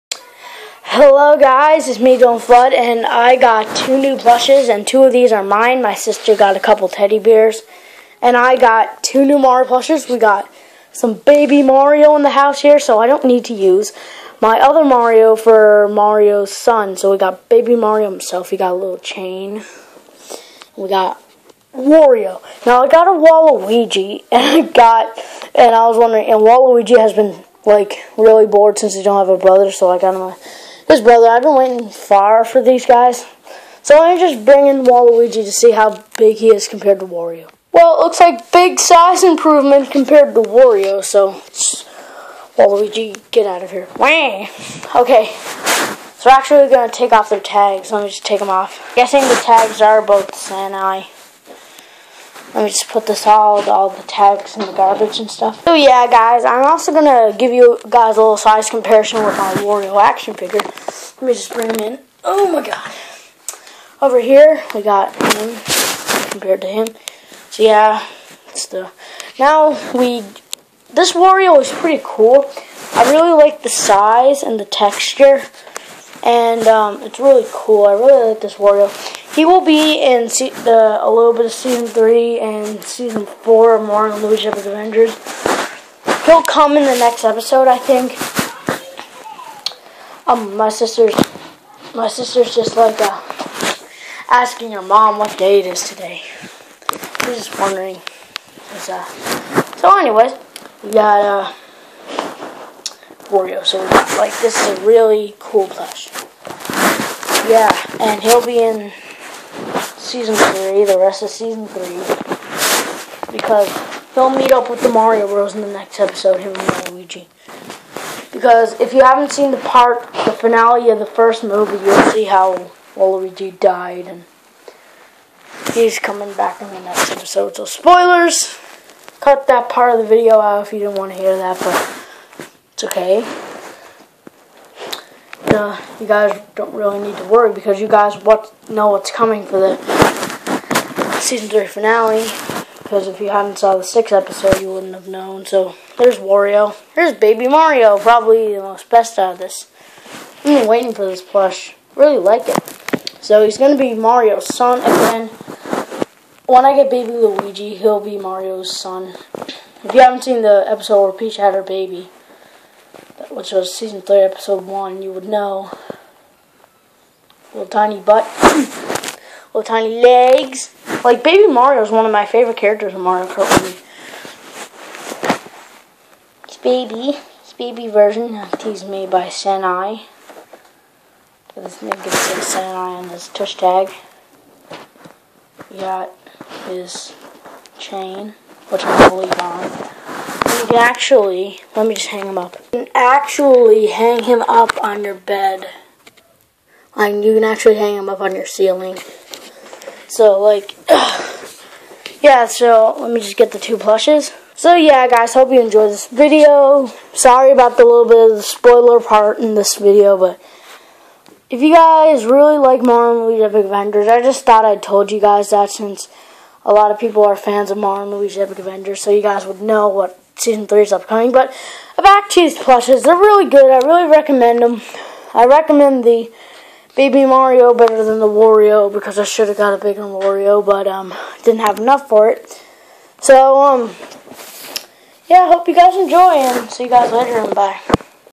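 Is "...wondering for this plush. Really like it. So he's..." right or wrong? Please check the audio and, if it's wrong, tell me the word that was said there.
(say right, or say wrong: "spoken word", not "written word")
wrong: "waiting", not "wondering".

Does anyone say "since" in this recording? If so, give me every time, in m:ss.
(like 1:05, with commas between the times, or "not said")
0:28, 3:35.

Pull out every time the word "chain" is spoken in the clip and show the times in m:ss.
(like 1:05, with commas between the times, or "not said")
0:18, 3:07.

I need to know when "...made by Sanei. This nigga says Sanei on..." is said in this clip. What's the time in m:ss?
2:58.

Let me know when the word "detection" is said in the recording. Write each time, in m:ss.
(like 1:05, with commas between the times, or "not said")
not said.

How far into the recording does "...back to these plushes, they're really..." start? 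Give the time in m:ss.
3:42.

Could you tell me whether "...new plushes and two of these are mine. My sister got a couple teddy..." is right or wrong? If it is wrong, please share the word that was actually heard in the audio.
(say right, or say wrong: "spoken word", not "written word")
right.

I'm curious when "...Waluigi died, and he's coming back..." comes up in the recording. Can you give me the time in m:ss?
2:02.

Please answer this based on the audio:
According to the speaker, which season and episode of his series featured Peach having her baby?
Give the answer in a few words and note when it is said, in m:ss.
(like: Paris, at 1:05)
Season 3, episode 1, at 2:43.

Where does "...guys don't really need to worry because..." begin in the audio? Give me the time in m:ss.
2:16.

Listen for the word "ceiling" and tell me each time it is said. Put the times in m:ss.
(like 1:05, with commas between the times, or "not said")
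3:18.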